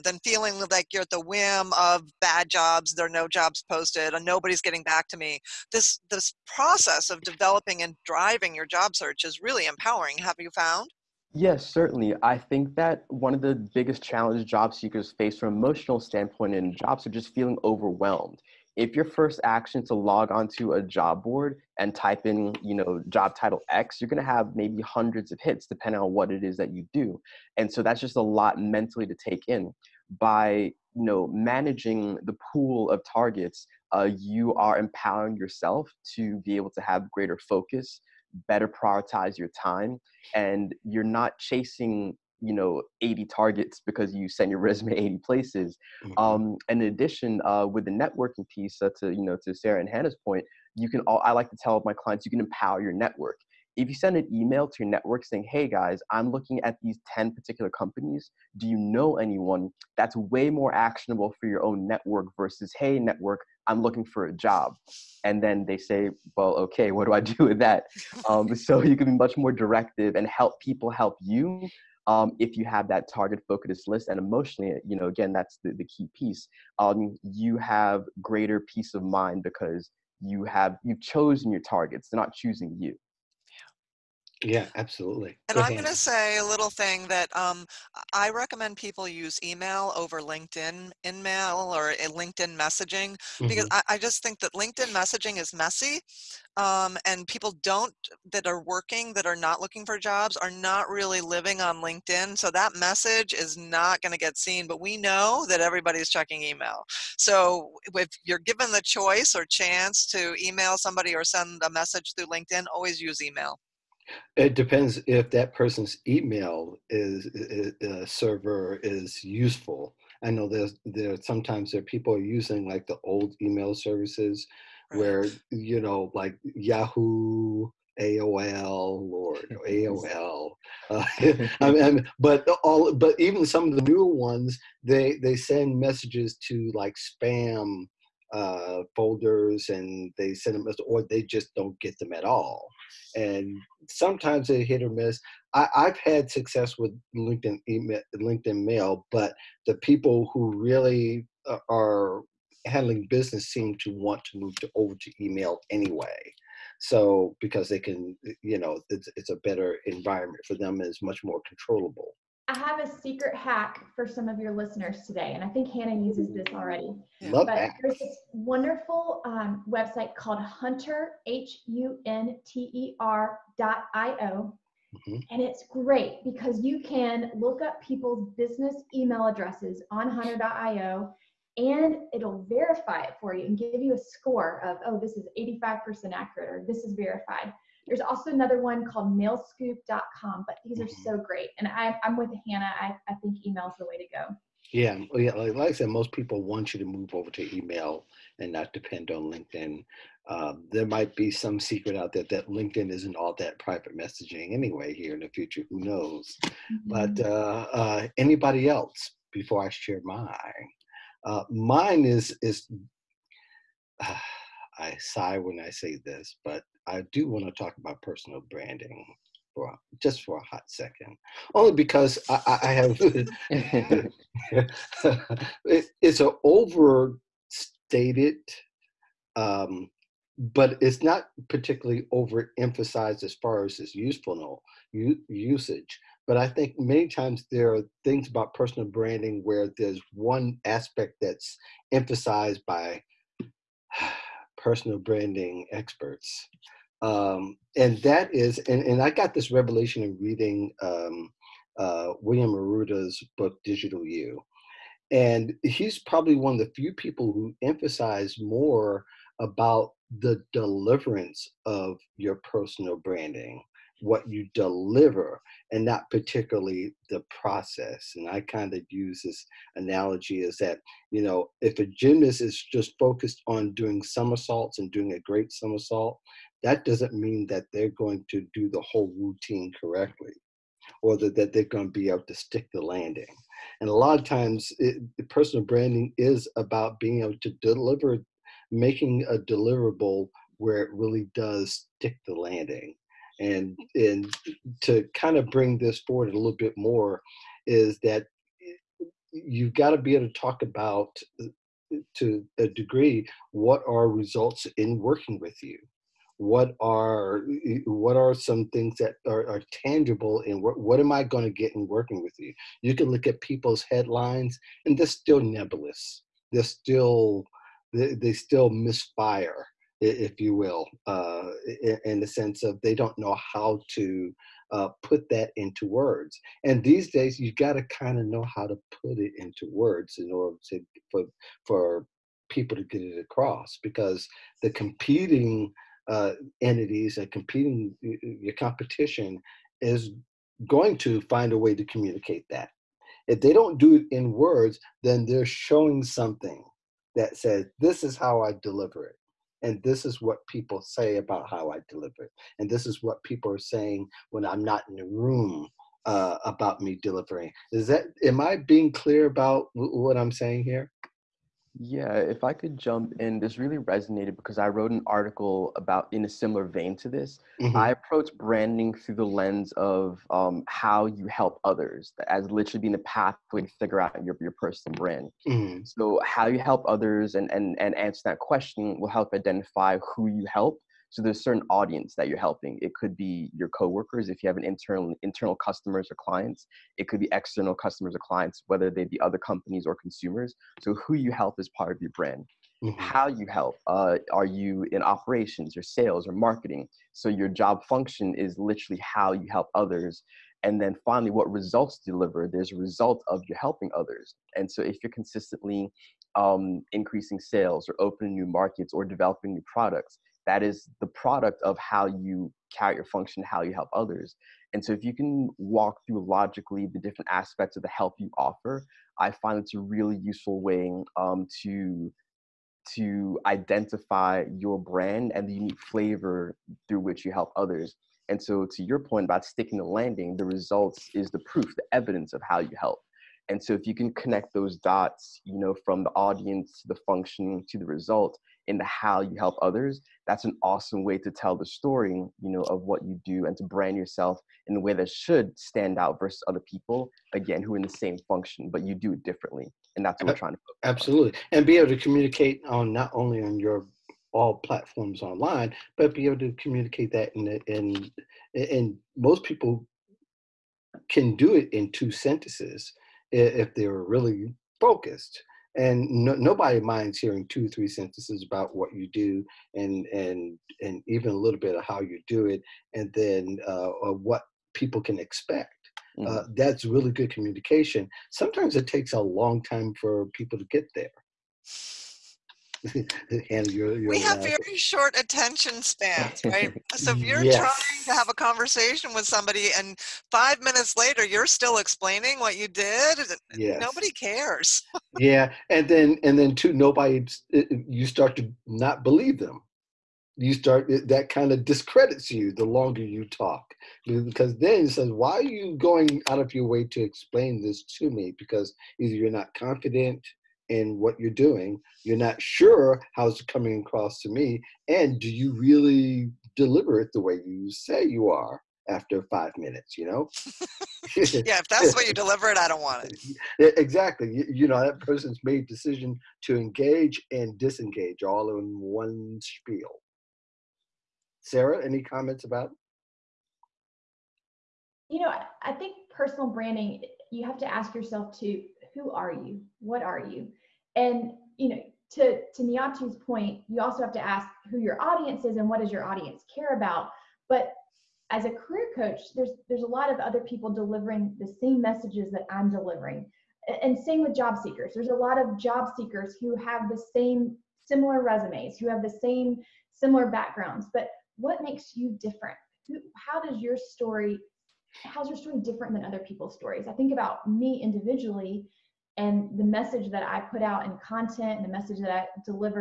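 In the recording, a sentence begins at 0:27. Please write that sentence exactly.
And so that's just a lot mentally to take in.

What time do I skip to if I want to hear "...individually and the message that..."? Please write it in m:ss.
9:27.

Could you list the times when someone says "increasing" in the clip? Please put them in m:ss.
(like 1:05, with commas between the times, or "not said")
6:46.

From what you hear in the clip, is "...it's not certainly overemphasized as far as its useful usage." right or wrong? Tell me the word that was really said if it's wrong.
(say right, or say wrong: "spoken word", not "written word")
wrong: "particularly", not "certainly".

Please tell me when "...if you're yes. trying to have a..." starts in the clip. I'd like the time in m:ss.
8:07.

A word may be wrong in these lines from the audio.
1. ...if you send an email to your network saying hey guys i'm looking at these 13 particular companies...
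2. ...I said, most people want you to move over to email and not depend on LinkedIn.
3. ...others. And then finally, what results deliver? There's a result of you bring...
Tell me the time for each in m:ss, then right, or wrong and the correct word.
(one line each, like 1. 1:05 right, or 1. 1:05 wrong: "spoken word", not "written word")
1. 0:53 wrong: "10", not "13"
2. 3:15 right
3. 6:39 wrong: "helping", not "bring".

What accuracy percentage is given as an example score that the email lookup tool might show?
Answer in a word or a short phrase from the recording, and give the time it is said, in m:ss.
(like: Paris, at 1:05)
85%, at 3:05.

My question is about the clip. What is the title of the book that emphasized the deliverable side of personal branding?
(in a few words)
Digital You.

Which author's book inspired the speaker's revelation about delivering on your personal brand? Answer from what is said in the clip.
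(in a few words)
William Arruda.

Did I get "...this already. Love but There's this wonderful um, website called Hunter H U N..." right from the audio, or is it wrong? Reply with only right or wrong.
right.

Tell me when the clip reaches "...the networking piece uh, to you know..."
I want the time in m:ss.
0:47.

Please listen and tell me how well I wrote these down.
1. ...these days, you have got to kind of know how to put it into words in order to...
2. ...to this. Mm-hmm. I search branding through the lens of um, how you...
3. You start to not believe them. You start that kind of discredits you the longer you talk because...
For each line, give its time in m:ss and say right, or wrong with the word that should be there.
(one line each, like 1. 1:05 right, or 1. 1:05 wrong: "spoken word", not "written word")
1. 5:26 right
2. 6:06 wrong: "approach", not "search"
3. 8:17 right.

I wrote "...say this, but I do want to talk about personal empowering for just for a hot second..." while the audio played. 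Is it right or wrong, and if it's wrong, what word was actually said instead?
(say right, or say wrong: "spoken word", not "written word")
wrong: "branding", not "empowering".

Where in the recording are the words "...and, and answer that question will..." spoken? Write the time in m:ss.
6:17.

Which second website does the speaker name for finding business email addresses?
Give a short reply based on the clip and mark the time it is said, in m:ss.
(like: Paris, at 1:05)
mailscoop.com, at 3:09.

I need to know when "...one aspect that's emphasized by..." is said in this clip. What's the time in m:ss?
4:00.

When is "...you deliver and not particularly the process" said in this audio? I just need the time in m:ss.
4:24.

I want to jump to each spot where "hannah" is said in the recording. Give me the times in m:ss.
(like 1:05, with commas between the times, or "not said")
0:49, 2:45, 3:12.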